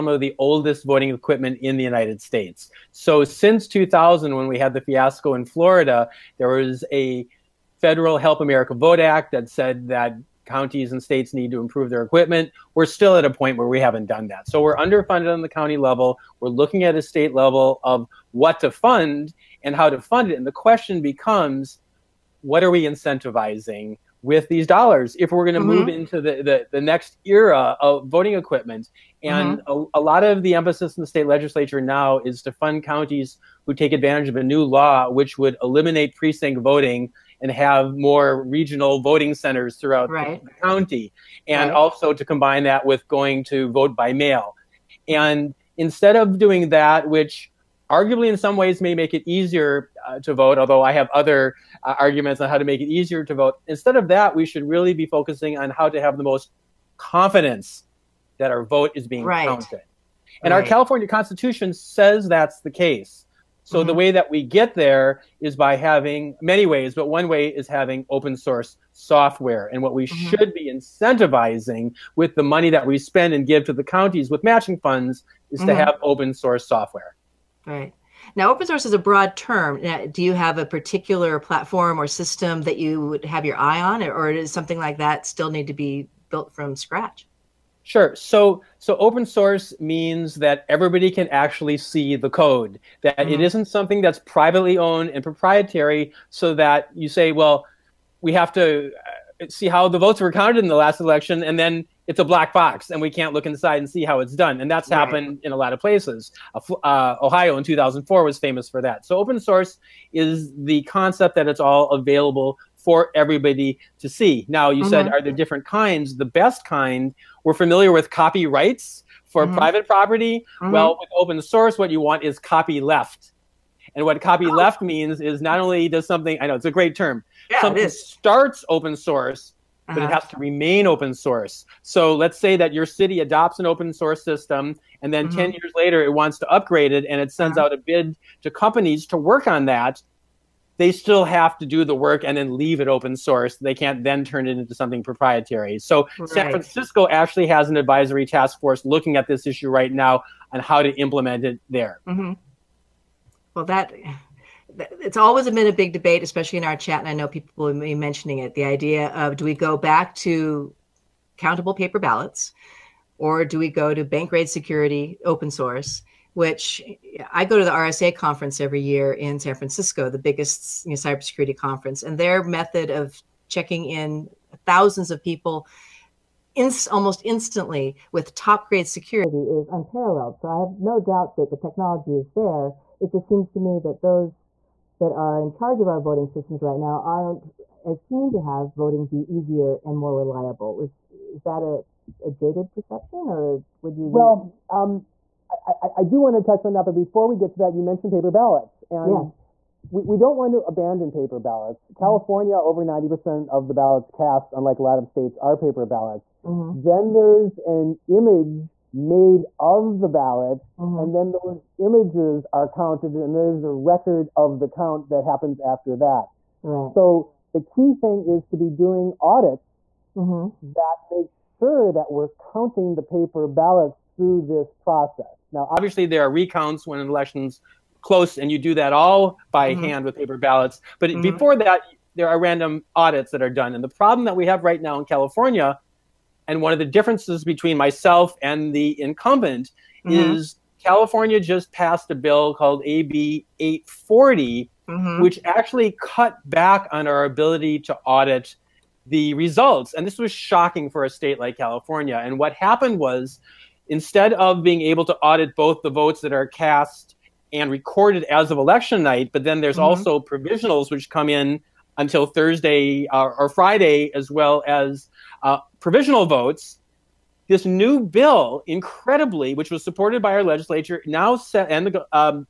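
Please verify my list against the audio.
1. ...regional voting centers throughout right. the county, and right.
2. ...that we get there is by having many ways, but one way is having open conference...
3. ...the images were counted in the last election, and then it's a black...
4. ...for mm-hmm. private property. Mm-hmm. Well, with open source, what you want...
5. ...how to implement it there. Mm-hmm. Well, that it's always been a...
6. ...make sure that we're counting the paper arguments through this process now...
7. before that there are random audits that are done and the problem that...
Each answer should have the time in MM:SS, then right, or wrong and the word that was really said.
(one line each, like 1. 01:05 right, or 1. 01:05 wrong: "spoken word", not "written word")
1. 00:38 right
2. 01:04 wrong: "source", not "conference"
3. 01:39 wrong: "votes", not "images"
4. 01:59 right
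5. 02:30 right
6. 03:41 wrong: "ballots", not "arguments"
7. 03:51 right.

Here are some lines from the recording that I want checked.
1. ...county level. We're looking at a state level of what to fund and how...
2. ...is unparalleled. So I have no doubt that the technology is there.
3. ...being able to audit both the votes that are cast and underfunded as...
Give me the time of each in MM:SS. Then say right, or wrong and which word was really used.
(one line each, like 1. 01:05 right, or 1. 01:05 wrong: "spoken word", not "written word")
1. 00:15 right
2. 02:59 right
3. 04:14 wrong: "recorded", not "underfunded".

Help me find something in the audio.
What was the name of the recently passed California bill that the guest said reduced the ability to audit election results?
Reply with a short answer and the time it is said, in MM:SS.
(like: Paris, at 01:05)
AB 840, at 04:02.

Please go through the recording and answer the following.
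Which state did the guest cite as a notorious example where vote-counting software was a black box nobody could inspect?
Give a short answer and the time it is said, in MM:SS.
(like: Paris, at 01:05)
Ohio, at 01:47.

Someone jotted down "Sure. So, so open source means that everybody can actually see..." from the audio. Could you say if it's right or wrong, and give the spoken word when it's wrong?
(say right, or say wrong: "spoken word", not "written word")
right.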